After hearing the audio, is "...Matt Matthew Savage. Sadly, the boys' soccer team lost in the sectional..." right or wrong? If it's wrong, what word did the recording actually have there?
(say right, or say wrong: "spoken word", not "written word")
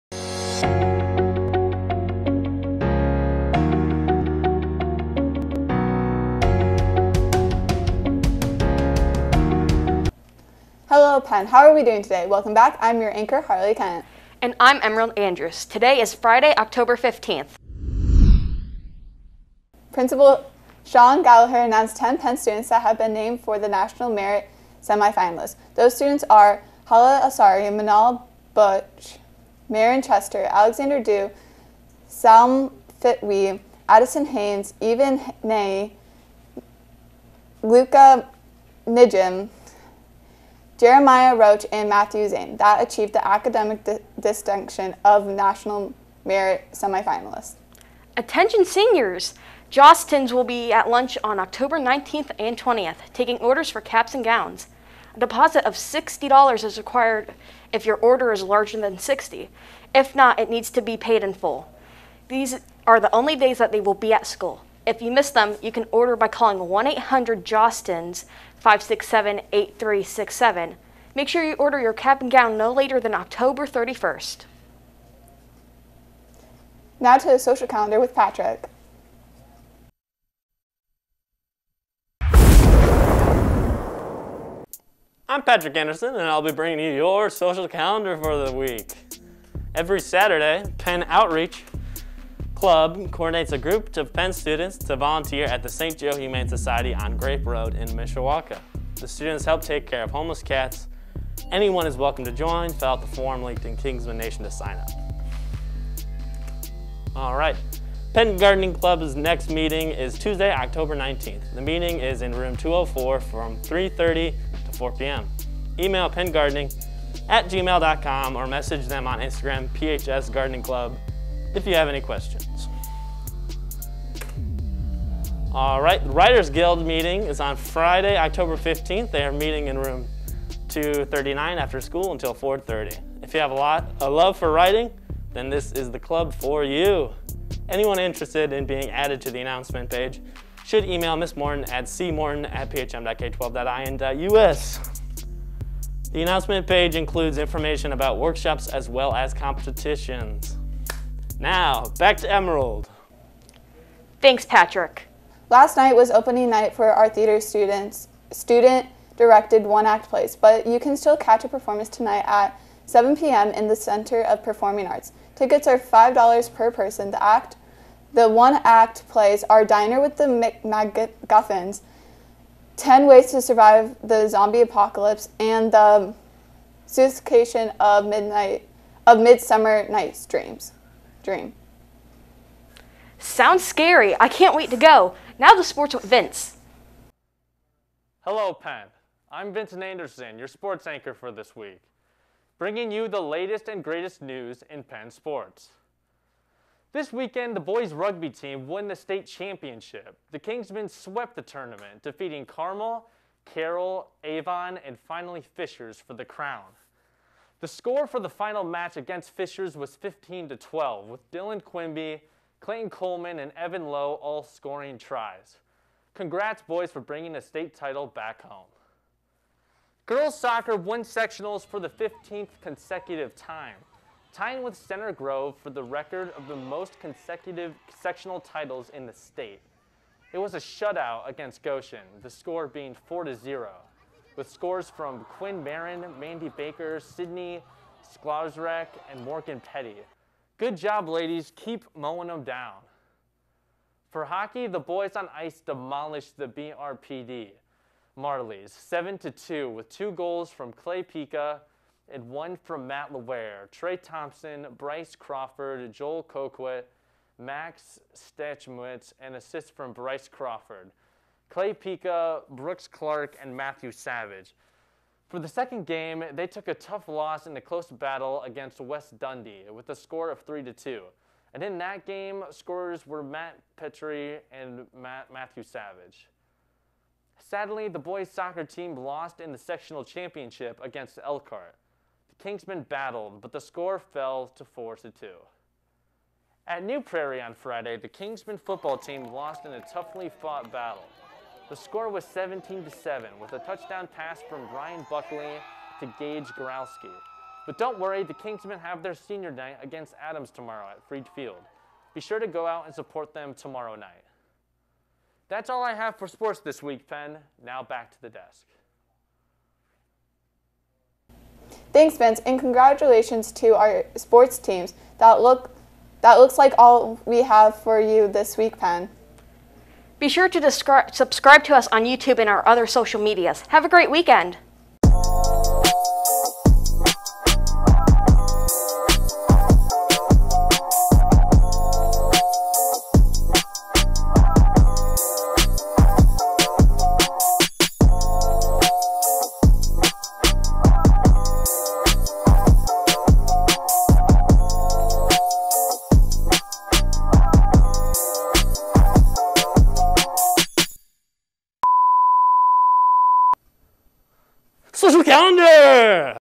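right.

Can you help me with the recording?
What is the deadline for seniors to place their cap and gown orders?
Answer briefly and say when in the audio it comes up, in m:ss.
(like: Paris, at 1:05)
October 31st, at 1:13.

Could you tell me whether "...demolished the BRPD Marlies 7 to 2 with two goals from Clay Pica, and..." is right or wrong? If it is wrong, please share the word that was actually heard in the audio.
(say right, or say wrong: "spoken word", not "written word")
right.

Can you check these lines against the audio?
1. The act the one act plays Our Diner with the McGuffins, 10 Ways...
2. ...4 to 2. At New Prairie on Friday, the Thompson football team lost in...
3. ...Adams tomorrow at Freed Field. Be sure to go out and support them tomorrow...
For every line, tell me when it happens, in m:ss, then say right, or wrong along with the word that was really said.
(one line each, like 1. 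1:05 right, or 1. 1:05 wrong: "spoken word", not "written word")
1. 2:47 right
2. 4:44 wrong: "Kingsmen", not "Thompson"
3. 5:00 right.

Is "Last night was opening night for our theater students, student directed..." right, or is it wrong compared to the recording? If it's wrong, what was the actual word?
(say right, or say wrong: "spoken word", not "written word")
right.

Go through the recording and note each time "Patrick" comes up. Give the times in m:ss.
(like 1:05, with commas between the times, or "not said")
1:18, 1:25, 2:34.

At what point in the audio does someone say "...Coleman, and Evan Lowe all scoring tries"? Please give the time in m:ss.
3:32.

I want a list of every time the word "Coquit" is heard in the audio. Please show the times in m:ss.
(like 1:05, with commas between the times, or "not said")
4:16.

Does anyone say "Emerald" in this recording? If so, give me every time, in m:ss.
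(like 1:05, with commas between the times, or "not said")
0:14, 2:32.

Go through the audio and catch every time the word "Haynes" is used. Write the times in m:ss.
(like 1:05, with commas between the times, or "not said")
0:34.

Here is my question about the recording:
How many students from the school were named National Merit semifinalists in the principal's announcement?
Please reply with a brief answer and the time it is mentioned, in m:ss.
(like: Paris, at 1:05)
10, at 0:21.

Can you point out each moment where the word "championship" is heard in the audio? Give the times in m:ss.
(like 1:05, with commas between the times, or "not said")
3:19, 4:40.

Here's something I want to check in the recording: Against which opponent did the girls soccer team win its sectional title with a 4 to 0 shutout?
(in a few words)
Goshen.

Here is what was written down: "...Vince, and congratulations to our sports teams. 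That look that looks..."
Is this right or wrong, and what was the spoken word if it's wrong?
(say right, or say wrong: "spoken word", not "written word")
right.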